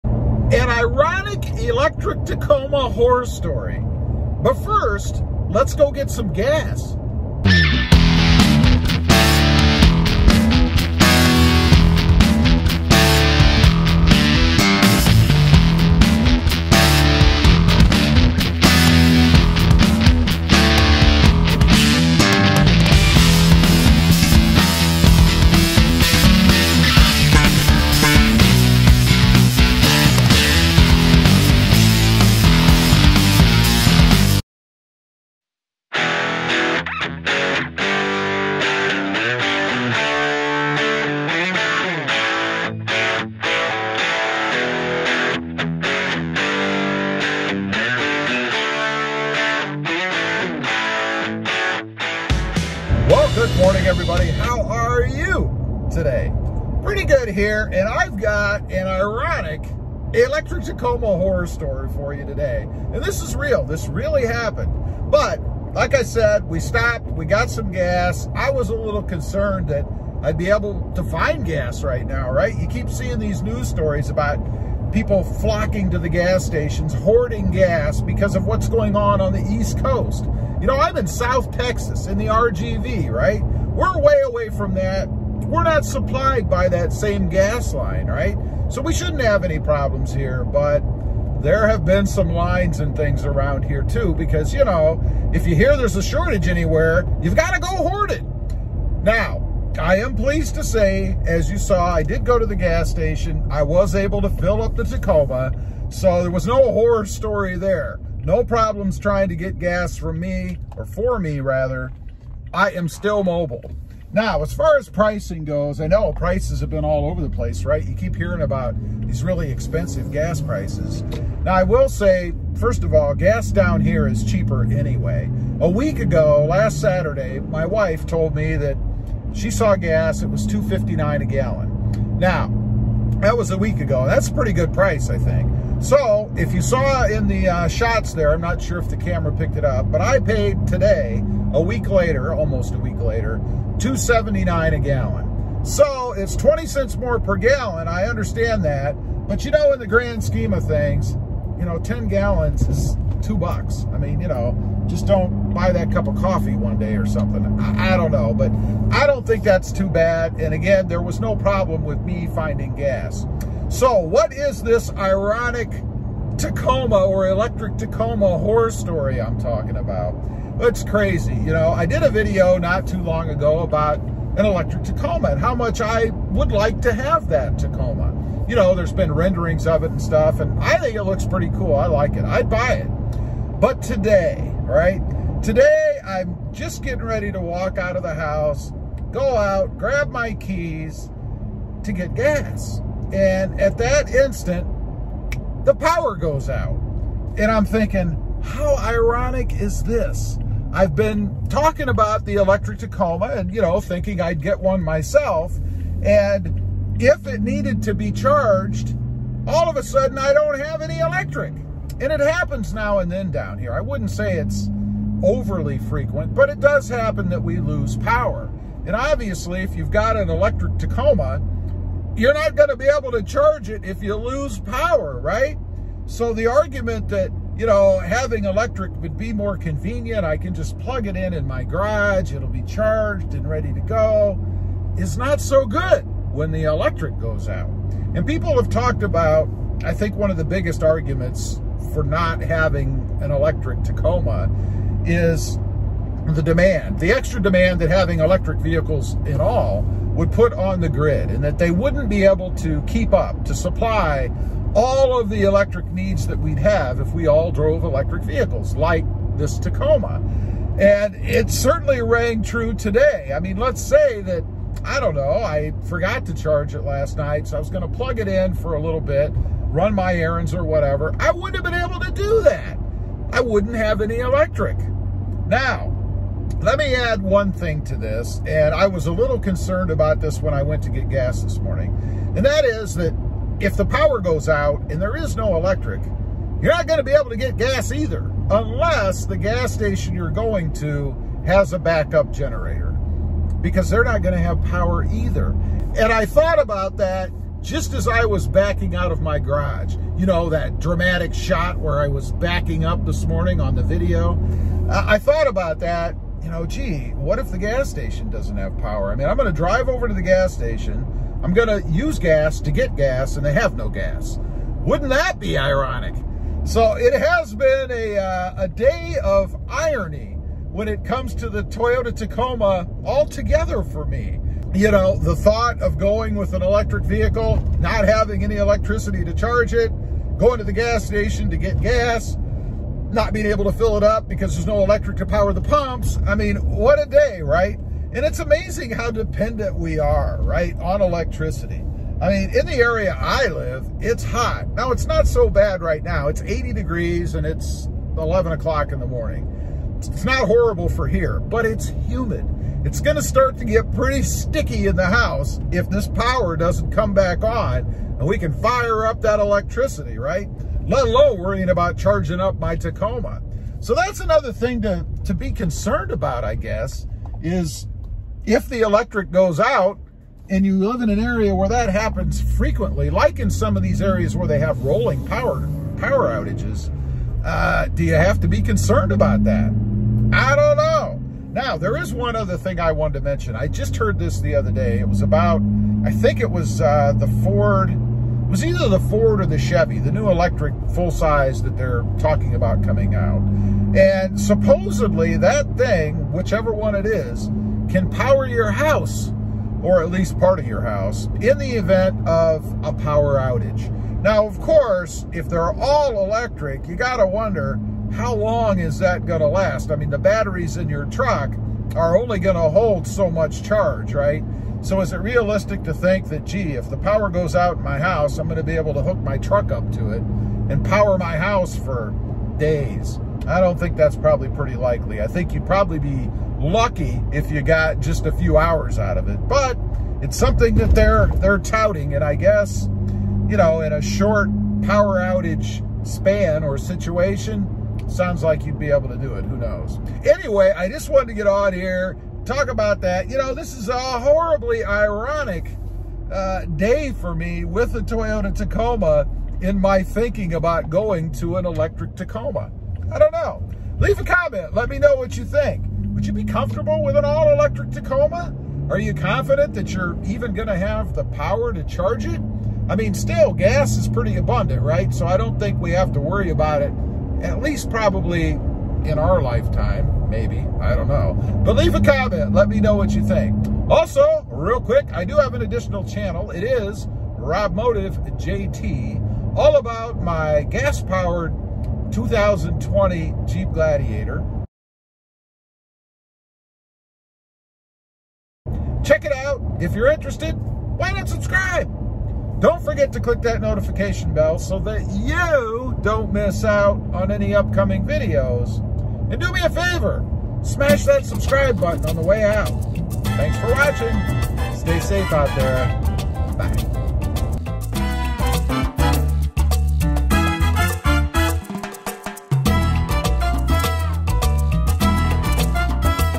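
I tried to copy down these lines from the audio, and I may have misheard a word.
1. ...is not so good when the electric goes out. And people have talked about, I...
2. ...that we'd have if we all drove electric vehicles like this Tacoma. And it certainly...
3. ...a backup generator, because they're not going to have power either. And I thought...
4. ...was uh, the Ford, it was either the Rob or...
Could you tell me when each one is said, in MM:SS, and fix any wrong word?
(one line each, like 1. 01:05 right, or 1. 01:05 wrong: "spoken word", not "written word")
1. 03:54 right
2. 04:16 right
3. 04:51 right
4. 06:26 wrong: "Ford", not "Rob".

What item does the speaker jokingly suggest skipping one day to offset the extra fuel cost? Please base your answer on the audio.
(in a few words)
cup of coffee.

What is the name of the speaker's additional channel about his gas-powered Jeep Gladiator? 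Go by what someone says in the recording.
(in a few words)
Rob Motive JT.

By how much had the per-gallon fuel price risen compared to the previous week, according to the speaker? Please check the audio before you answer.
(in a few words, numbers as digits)
20 cents.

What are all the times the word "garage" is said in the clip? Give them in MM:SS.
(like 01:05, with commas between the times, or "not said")
03:51, 04:59.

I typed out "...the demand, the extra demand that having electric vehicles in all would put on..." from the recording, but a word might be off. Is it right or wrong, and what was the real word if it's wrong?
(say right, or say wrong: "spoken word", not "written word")
right.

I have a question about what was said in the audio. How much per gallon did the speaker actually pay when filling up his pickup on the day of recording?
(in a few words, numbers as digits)
2.79.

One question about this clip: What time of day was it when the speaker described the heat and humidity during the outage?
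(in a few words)
11 o'clock.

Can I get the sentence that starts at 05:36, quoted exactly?
I mean, what a day, right?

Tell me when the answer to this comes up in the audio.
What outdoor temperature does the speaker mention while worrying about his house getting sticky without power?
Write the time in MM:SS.
05:46.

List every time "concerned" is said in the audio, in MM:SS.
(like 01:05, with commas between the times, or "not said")
01:09, 04:39, 06:05, 06:18.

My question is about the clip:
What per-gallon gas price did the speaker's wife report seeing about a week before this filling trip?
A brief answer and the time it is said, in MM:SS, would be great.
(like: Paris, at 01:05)
2.59, at 02:10.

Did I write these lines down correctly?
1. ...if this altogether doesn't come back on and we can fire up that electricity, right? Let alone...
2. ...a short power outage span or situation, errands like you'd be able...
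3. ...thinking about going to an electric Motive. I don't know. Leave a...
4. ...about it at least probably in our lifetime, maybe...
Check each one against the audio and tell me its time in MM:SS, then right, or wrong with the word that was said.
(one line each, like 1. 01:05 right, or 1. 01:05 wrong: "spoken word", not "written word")
1. 05:55 wrong: "power", not "altogether"
2. 07:13 wrong: "sounds", not "errands"
3. 07:30 wrong: "Tacoma", not "Motive"
4. 07:46 right.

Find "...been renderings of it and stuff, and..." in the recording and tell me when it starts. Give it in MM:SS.
02:58.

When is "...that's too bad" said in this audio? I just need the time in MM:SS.
02:39.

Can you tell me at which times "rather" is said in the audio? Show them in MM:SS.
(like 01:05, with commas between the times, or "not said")
01:51.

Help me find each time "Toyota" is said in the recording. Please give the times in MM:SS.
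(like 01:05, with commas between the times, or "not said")
05:21, 07:28.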